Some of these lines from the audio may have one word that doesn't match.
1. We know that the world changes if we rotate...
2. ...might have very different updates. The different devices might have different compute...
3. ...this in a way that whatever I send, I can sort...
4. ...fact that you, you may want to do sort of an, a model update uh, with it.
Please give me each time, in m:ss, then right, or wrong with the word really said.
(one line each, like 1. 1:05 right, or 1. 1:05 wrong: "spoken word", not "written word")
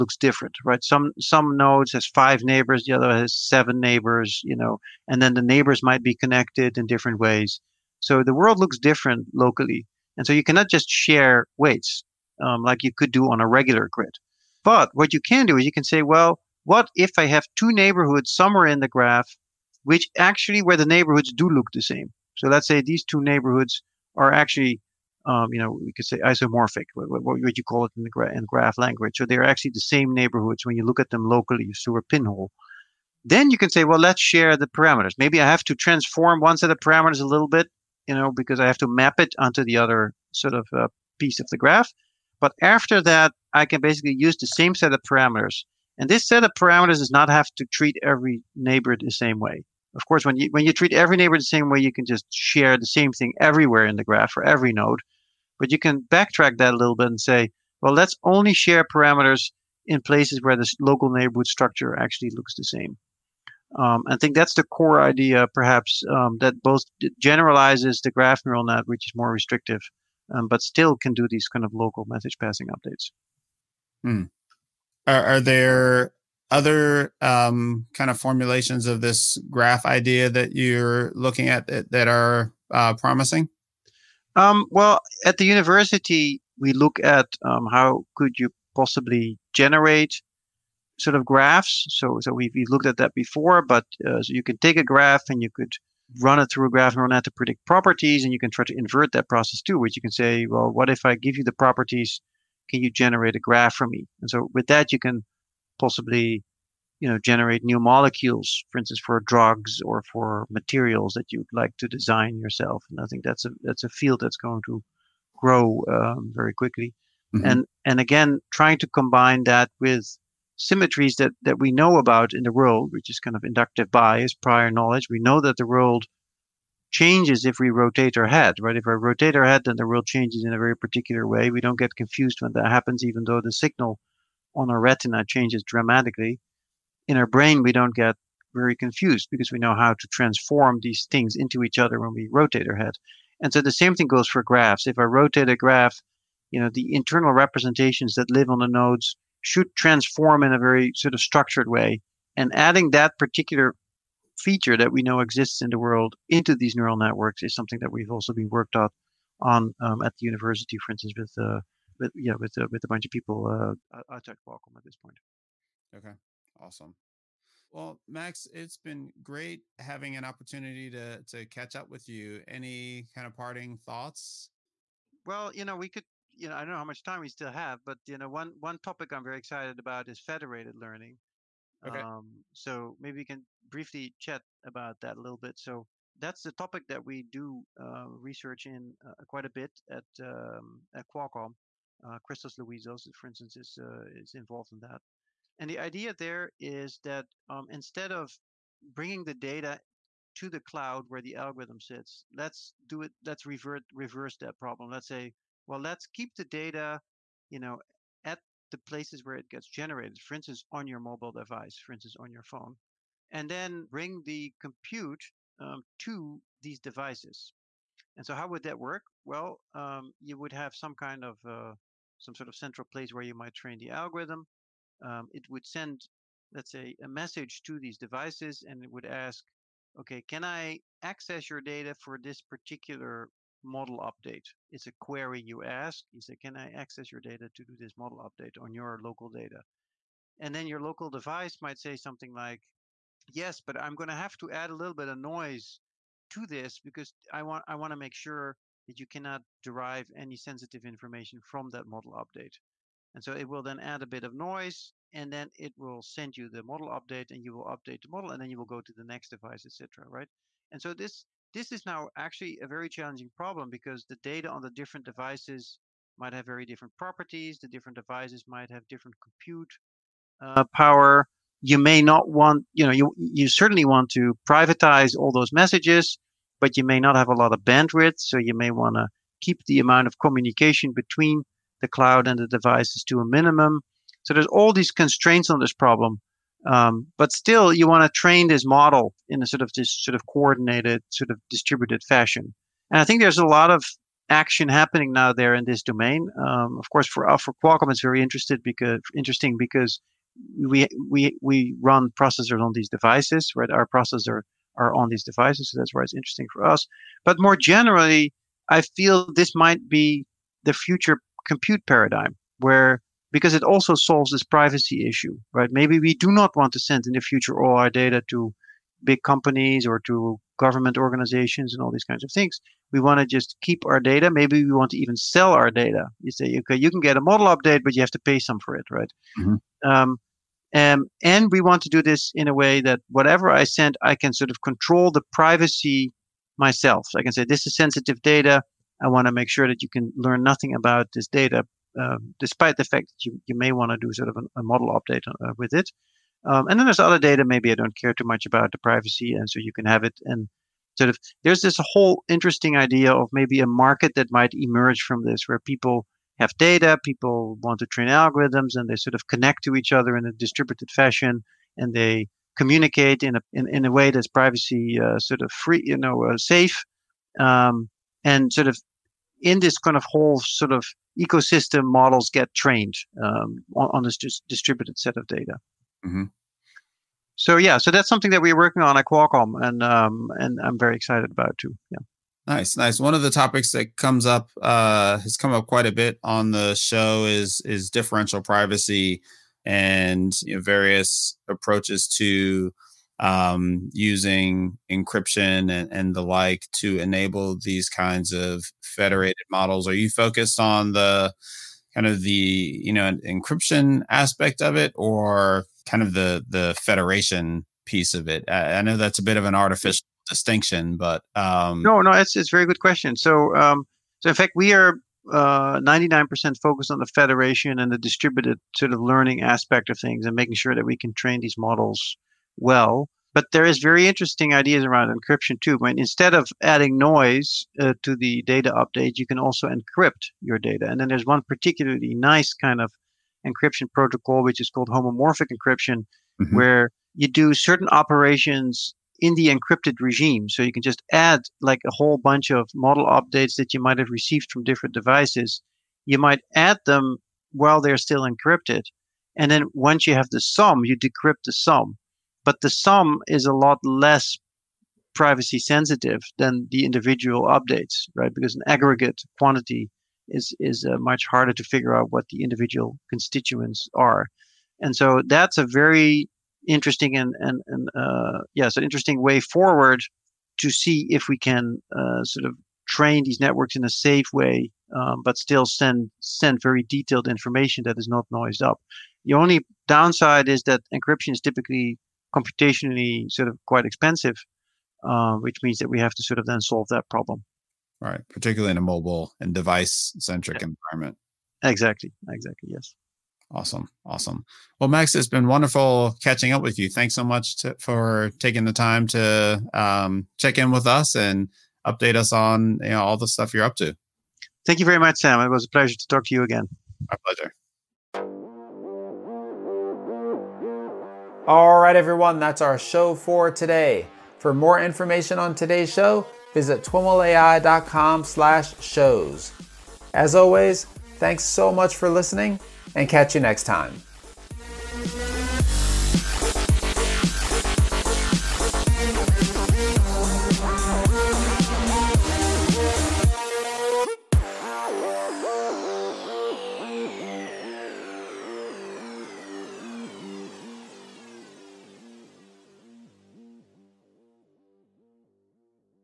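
1. 2:05 right
2. 4:26 wrong: "properties", not "updates"
3. 5:32 right
4. 5:42 right.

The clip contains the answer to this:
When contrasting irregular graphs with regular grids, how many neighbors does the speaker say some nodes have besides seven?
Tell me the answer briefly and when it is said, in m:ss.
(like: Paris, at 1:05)
5, at 0:02.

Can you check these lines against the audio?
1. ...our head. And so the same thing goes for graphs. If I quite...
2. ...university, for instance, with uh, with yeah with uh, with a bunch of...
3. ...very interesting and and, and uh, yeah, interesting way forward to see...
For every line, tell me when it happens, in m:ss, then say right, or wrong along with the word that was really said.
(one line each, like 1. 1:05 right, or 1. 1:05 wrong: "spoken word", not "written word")
1. 2:22 wrong: "rotate", not "quite"
2. 2:40 right
3. 7:45 right.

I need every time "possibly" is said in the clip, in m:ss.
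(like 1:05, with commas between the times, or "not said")
1:28, 1:45.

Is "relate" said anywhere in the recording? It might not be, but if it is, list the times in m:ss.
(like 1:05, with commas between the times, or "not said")
not said.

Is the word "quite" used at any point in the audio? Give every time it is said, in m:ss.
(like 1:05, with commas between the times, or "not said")
3:09, 6:25, 8:03.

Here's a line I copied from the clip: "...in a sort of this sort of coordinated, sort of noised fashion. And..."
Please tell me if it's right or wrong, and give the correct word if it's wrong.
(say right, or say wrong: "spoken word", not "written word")
wrong: "distributed", not "noised".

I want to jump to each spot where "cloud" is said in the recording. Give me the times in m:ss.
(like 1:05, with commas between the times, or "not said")
3:20, 4:41.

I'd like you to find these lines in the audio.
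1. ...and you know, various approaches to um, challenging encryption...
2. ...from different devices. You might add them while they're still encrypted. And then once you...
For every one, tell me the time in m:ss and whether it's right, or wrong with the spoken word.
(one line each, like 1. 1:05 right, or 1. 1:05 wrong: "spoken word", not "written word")
1. 6:29 wrong: "using", not "challenging"
2. 7:24 right.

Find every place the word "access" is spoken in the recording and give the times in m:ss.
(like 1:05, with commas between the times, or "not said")
3:51, 3:56.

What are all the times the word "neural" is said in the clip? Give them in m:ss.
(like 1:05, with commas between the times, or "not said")
1:08, 1:36, 2:36.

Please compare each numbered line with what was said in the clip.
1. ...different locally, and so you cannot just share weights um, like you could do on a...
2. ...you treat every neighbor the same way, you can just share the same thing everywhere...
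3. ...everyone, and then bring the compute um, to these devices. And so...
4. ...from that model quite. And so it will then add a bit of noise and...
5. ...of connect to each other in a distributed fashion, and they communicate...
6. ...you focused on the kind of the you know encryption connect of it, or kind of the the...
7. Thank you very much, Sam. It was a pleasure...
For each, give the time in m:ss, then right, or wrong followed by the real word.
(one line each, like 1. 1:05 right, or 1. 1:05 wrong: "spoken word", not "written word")
1. 0:08 right
2. 0:50 right
3. 3:32 wrong: "phone", not "everyone"
4. 4:11 wrong: "update", not "quite"
5. 5:59 right
6. 6:39 wrong: "aspect", not "connect"
7. 8:24 right.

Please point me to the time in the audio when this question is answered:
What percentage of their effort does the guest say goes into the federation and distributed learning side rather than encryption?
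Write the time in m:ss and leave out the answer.
6:55.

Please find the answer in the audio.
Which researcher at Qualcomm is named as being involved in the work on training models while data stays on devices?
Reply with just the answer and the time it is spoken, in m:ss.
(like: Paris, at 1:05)
Christos Louizos, at 3:12.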